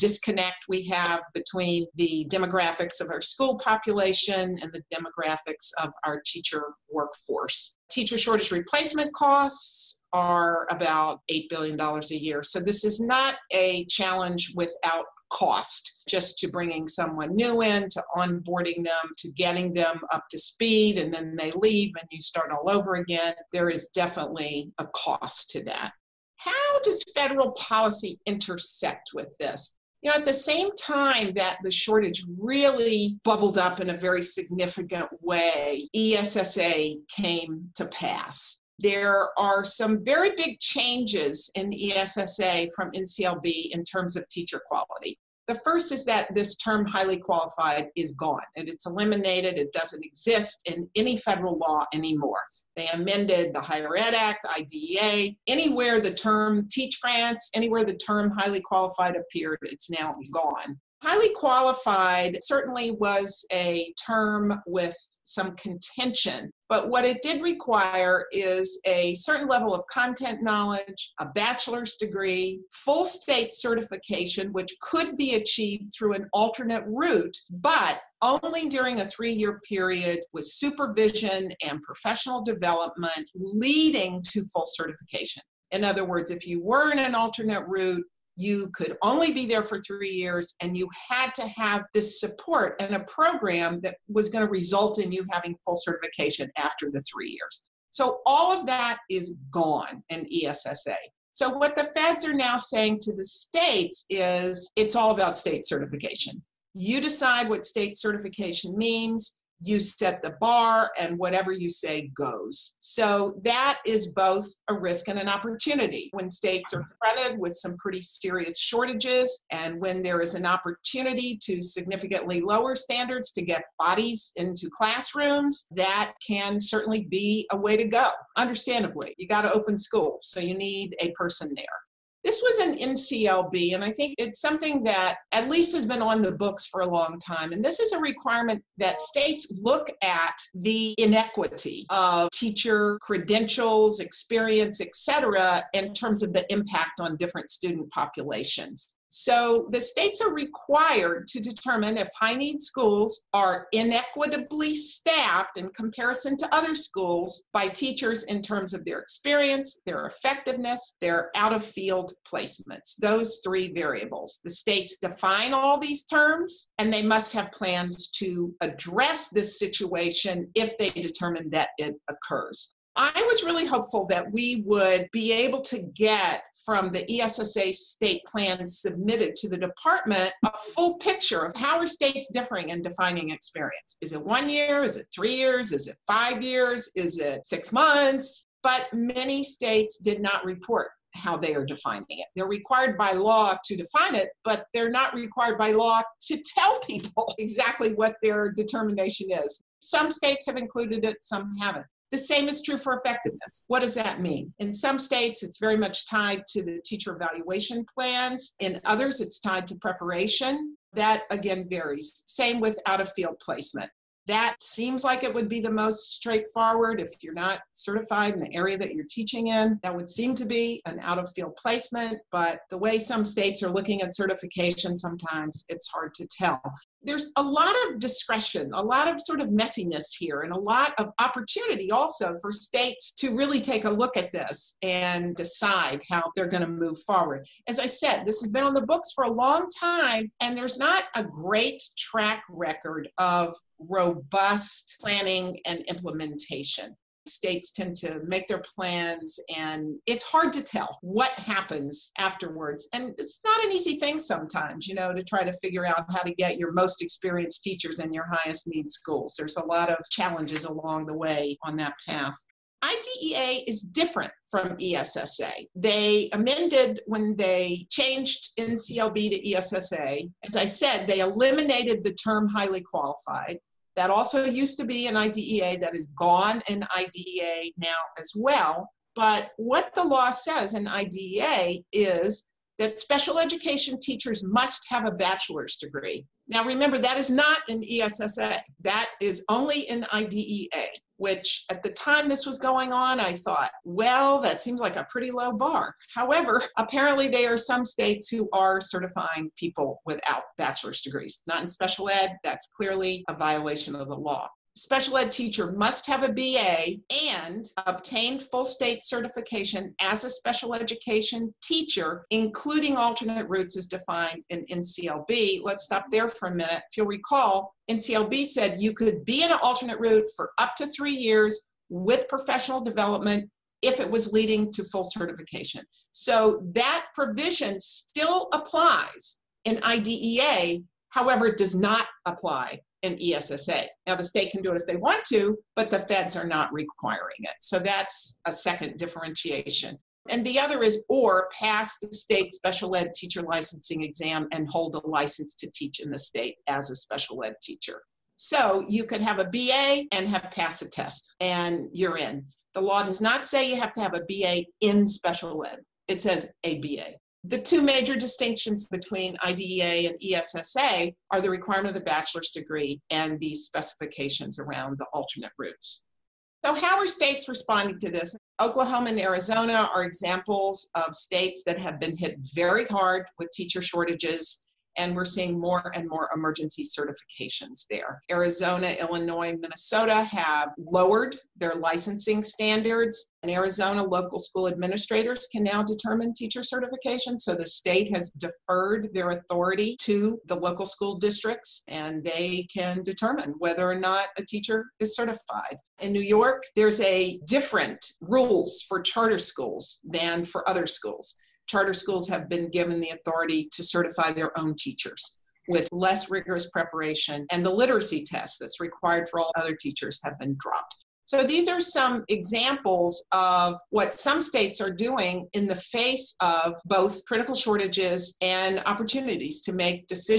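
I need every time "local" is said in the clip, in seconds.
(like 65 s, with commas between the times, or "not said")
384 s, 390 s.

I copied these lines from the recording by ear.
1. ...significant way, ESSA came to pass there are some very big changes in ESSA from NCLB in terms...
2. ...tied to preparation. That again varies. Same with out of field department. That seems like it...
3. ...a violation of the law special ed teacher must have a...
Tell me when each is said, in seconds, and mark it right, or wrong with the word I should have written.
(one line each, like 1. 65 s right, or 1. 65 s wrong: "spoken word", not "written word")
1. 34 s right
2. 209 s wrong: "placement", not "department"
3. 303 s right.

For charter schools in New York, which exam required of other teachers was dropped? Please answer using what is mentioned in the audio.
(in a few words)
literacy test.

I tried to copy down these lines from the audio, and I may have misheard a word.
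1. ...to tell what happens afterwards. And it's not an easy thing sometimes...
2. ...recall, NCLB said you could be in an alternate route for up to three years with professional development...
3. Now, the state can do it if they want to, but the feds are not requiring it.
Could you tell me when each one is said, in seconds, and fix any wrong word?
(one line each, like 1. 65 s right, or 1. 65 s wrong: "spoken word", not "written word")
1. 250 s right
2. 317 s right
3. 334 s right.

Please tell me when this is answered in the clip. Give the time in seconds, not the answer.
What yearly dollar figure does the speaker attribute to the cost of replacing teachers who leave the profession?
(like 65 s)
11 s.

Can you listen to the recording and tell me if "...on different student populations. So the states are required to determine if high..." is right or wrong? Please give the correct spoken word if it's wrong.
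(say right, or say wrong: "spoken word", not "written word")
right.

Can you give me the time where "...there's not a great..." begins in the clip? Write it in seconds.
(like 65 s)
240 s.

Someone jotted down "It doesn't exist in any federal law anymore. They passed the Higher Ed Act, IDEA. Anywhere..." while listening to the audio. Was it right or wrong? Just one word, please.
wrong.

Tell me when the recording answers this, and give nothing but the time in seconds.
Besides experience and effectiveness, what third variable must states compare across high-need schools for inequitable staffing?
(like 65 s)
161 s.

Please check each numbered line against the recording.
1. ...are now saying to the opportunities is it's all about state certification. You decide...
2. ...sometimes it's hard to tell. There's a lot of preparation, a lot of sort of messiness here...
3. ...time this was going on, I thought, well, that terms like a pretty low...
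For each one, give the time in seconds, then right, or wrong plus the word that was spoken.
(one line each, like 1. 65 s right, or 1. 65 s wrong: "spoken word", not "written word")
1. 102 s wrong: "states", not "opportunities"
2. 224 s wrong: "discretion", not "preparation"
3. 291 s wrong: "seems", not "terms".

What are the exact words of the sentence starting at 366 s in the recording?
So, how are states responding to this?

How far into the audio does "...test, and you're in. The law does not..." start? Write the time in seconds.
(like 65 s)
350 s.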